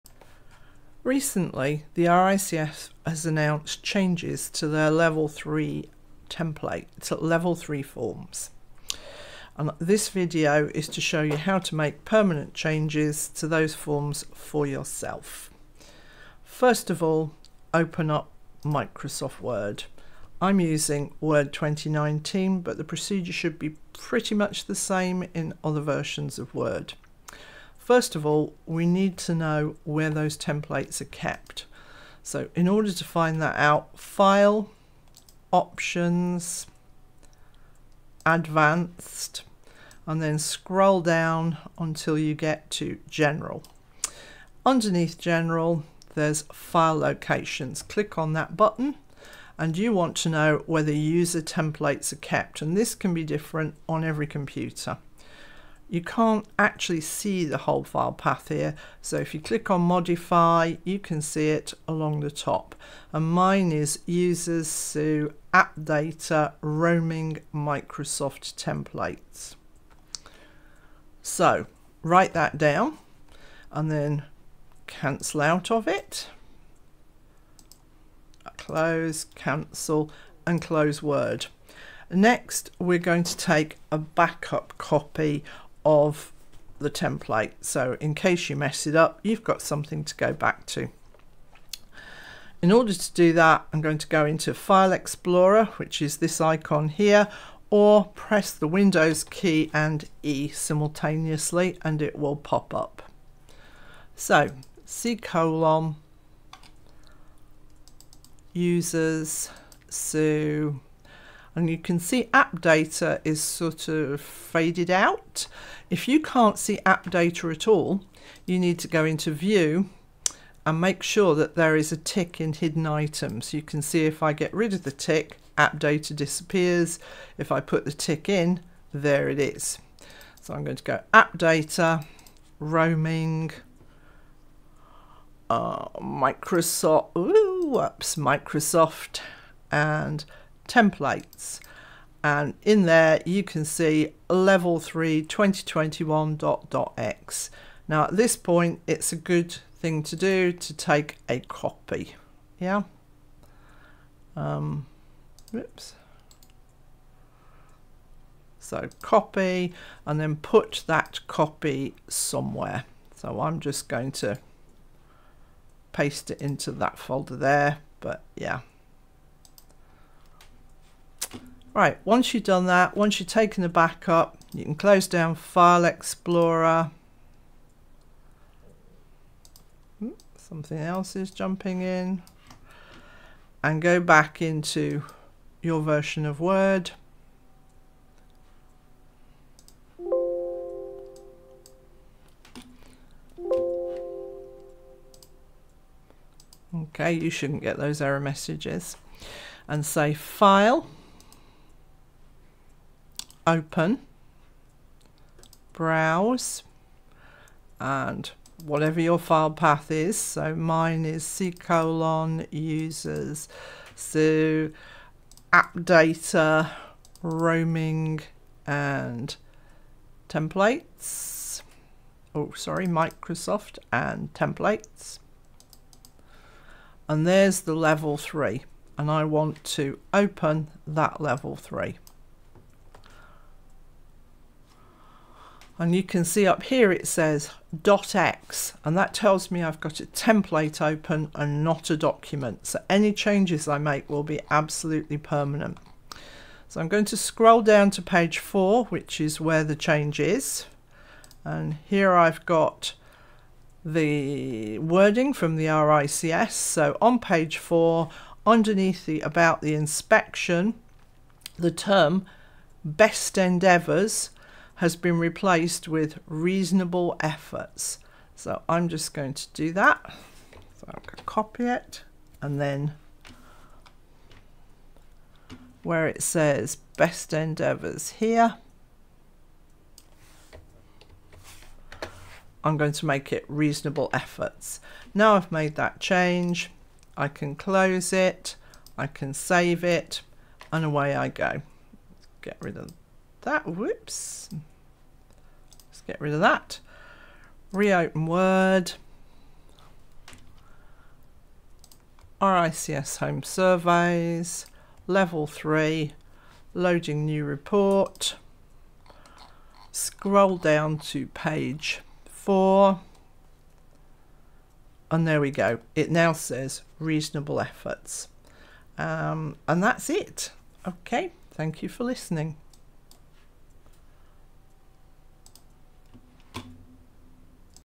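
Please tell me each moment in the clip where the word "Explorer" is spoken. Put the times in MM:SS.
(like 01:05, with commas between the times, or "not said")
01:34, 02:55.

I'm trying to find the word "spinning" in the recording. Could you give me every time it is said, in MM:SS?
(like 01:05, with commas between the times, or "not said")
not said.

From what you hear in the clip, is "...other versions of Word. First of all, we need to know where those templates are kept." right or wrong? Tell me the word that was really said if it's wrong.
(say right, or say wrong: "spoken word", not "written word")
right.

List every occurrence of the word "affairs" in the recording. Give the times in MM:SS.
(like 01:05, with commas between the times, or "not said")
not said.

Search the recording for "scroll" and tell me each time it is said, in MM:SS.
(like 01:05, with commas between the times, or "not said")
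00:40, 04:07, 05:09.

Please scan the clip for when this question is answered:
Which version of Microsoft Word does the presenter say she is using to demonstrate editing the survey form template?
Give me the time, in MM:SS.
00:21.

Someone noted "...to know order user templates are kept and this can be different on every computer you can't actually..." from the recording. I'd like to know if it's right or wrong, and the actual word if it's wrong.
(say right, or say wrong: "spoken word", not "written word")
wrong: "whether", not "order".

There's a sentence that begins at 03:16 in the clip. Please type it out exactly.
Okay, you shouldn't get those error messages.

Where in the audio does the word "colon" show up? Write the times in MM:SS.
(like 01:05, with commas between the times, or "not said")
01:45, 03:31.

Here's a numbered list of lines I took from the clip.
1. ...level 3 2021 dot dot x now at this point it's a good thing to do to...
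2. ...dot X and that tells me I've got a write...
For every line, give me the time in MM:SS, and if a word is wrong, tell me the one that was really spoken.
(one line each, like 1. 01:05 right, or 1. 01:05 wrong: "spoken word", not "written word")
1. 02:24 right
2. 03:57 wrong: "template", not "write".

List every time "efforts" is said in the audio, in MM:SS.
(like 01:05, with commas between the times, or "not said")
04:27, 04:44, 05:17.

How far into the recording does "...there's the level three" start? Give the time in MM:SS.
03:47.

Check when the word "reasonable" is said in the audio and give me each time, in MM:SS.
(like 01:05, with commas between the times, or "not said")
04:26, 04:43, 05:16.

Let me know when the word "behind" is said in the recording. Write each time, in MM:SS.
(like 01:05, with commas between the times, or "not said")
not said.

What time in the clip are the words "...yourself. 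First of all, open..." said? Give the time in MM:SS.
00:14.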